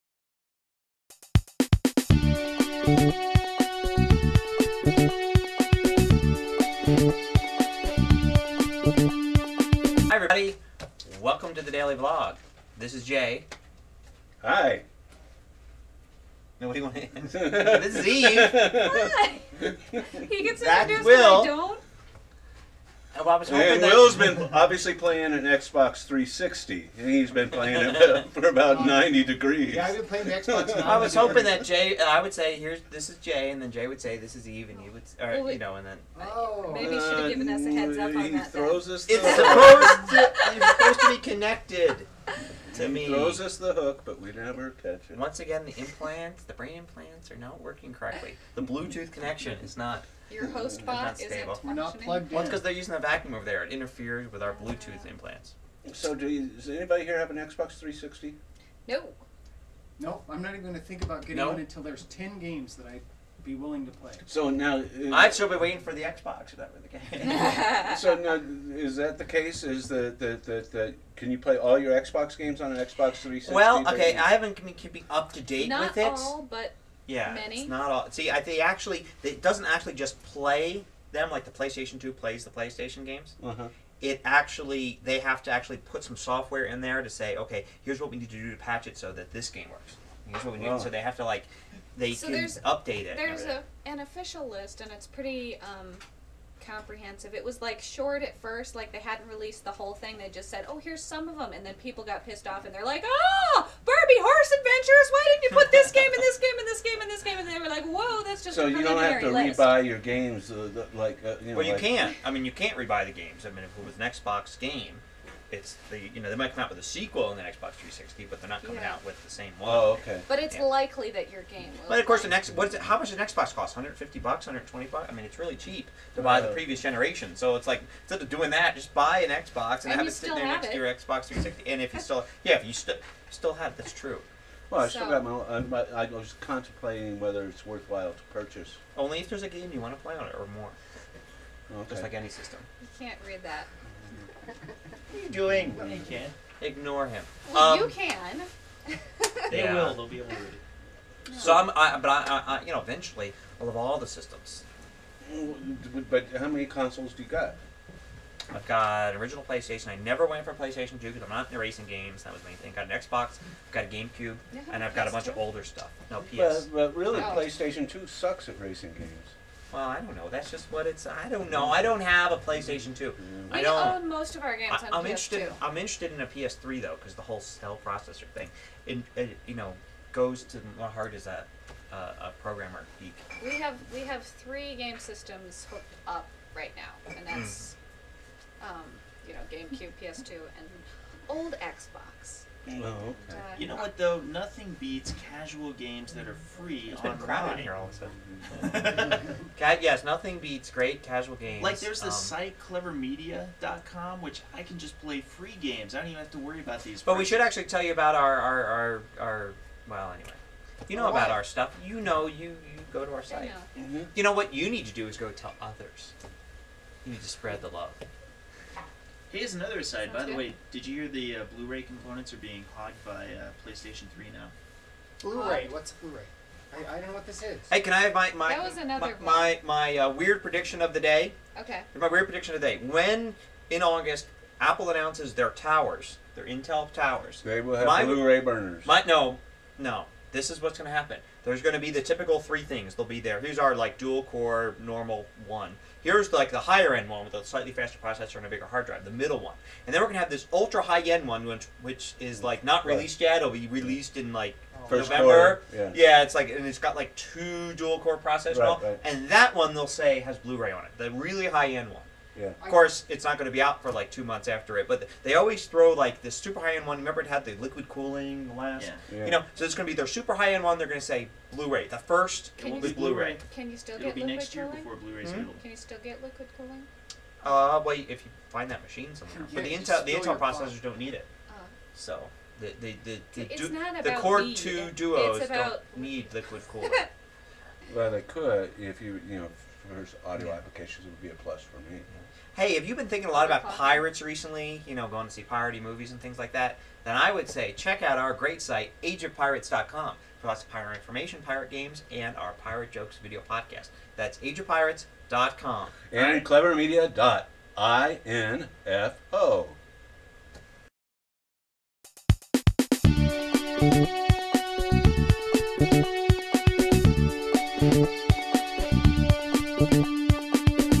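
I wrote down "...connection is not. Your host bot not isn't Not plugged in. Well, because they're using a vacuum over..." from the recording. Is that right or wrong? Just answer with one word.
right.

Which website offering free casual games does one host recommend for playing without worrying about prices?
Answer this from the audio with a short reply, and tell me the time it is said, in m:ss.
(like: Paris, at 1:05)
clevermedia.com, at 3:22.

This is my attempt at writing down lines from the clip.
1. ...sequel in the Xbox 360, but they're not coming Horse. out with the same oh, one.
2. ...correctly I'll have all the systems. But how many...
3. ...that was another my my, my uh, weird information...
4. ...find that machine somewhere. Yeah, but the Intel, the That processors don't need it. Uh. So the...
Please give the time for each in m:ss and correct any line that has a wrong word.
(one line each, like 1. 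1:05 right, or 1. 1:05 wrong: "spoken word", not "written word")
1. 1:56 wrong: "Yeah", not "Horse"
2. 2:32 wrong: "eventually", not "correctly"
3. 3:48 wrong: "prediction", not "information"
4. 4:38 wrong: "Intel", not "That".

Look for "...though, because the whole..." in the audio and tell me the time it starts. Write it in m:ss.
2:56.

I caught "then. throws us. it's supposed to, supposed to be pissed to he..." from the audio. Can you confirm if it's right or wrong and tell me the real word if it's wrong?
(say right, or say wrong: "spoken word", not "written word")
wrong: "connected", not "pissed".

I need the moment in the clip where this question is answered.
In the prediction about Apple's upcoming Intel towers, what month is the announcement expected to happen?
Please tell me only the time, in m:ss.
3:53.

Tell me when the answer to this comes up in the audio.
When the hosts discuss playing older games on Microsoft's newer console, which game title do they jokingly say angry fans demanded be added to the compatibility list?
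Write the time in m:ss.
1:43.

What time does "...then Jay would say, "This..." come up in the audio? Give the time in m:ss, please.
0:33.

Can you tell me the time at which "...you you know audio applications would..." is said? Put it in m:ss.
4:49.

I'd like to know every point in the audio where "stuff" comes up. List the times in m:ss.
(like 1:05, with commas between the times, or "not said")
2:45, 3:31.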